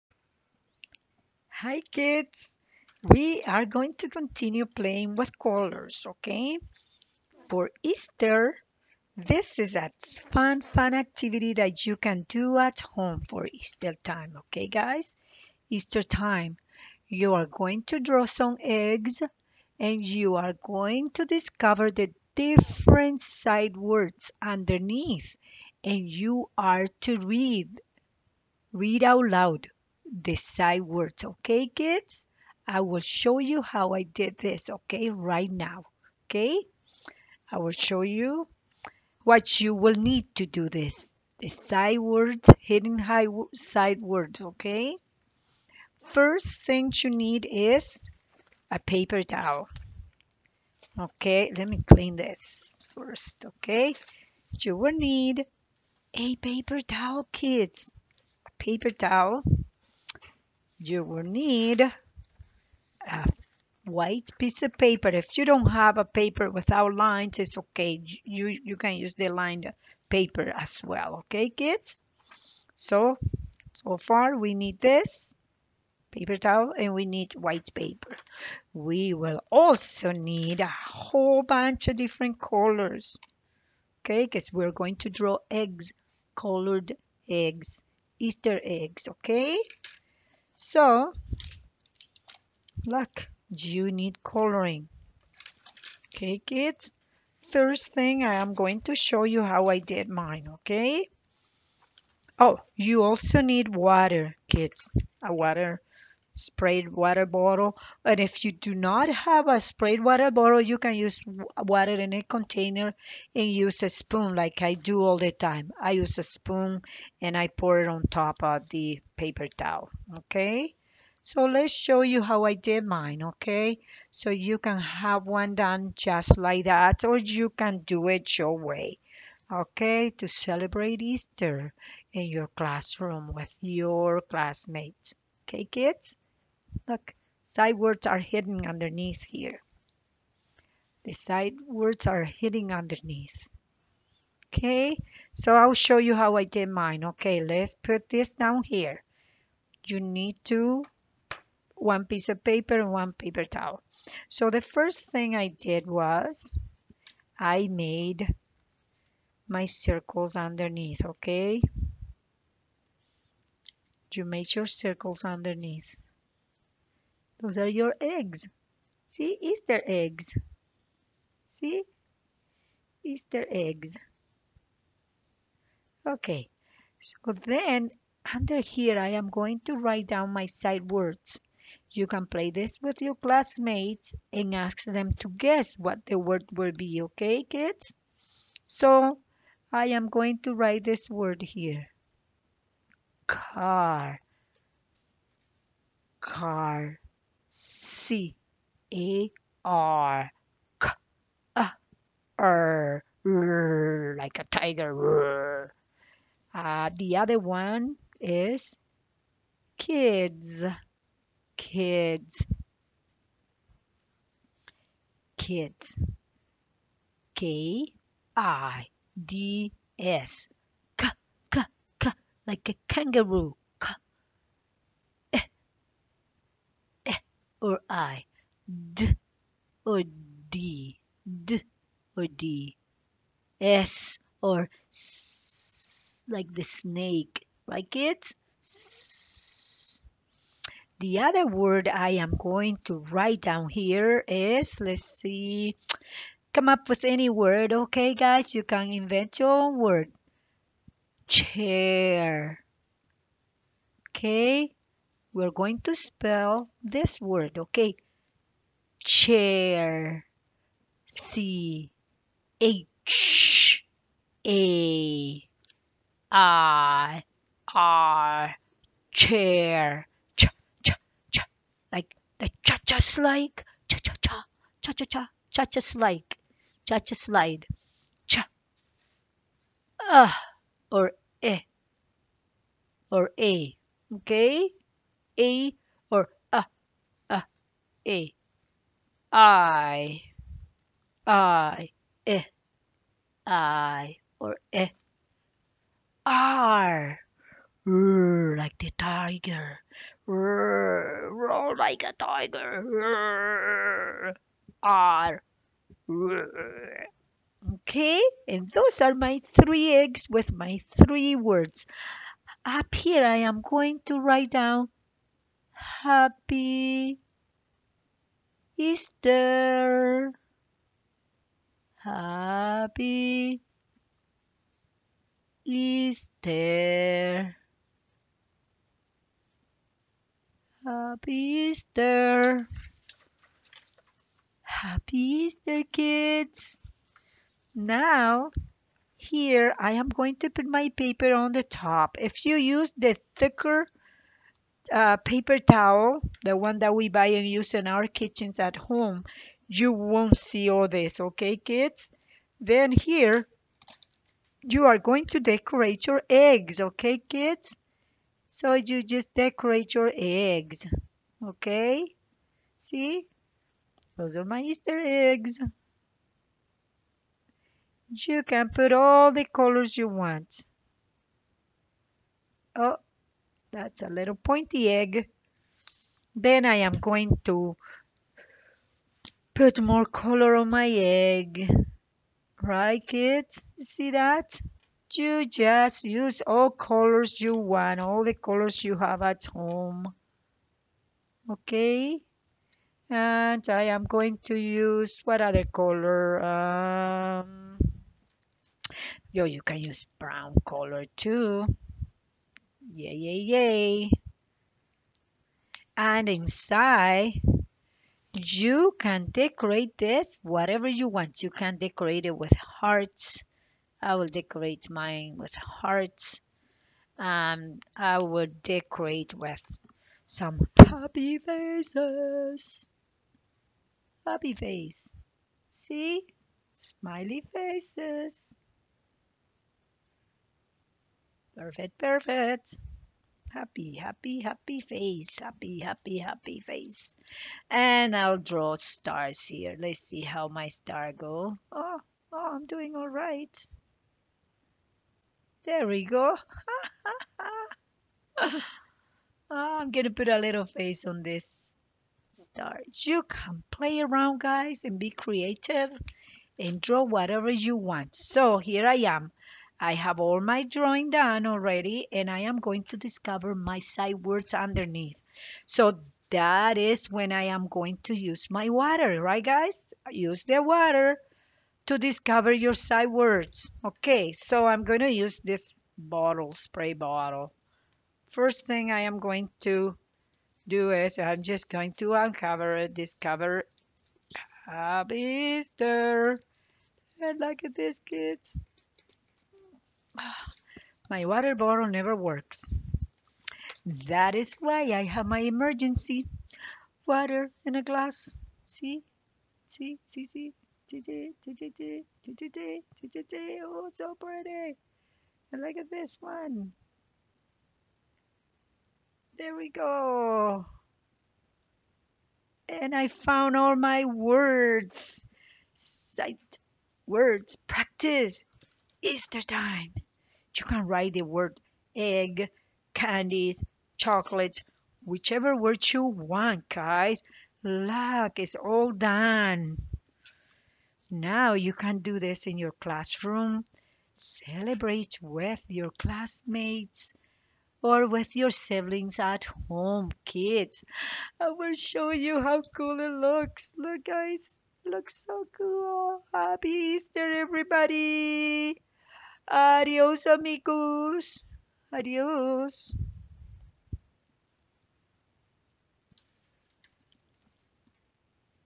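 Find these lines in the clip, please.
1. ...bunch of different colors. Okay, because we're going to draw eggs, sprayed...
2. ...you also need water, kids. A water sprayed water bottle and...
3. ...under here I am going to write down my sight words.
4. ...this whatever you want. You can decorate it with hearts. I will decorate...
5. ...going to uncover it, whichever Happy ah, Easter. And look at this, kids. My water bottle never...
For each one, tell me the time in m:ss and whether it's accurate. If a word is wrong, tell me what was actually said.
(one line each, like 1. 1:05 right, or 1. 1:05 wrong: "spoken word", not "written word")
1. 1:21 wrong: "colored", not "sprayed"
2. 1:42 right
3. 2:58 right
4. 6:49 right
5. 8:01 wrong: "discover", not "whichever".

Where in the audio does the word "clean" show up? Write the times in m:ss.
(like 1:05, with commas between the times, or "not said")
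0:51.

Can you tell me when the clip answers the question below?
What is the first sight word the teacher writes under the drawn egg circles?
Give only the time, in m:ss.
3:13.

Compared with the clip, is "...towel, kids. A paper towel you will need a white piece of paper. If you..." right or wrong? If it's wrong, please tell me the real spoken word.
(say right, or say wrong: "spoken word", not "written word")
right.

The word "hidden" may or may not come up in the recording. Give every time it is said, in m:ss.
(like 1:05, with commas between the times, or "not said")
0:42, 2:18, 2:22.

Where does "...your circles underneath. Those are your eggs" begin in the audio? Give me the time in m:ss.
2:44.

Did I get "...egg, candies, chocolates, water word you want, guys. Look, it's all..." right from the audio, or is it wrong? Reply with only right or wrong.
wrong.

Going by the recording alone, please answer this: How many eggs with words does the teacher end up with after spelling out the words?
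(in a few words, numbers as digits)
3.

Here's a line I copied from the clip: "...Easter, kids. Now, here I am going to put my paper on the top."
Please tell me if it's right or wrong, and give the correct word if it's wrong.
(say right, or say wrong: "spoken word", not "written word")
right.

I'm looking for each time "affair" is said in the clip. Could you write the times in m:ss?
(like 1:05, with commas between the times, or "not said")
not said.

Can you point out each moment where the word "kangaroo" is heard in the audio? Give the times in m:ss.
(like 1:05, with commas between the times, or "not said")
3:42.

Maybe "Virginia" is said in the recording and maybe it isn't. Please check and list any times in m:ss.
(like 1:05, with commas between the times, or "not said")
not said.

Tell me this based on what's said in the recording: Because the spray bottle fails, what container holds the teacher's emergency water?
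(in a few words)
a glass.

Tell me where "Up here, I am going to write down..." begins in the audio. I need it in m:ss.
5:12.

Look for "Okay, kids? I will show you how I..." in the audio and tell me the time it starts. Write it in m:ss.
0:31.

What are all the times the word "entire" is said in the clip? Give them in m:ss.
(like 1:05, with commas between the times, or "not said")
not said.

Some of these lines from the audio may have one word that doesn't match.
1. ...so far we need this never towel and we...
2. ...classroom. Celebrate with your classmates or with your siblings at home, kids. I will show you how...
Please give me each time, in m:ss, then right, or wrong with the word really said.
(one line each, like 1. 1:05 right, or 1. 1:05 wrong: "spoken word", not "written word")
1. 1:13 wrong: "paper", not "never"
2. 8:52 right.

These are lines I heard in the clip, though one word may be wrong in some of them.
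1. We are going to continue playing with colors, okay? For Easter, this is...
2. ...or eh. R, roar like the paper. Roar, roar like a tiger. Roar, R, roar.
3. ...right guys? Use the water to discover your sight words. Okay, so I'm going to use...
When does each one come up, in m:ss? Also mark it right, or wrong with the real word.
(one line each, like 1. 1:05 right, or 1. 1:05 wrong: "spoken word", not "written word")
1. 0:03 right
2. 4:54 wrong: "tiger", not "paper"
3. 7:49 right.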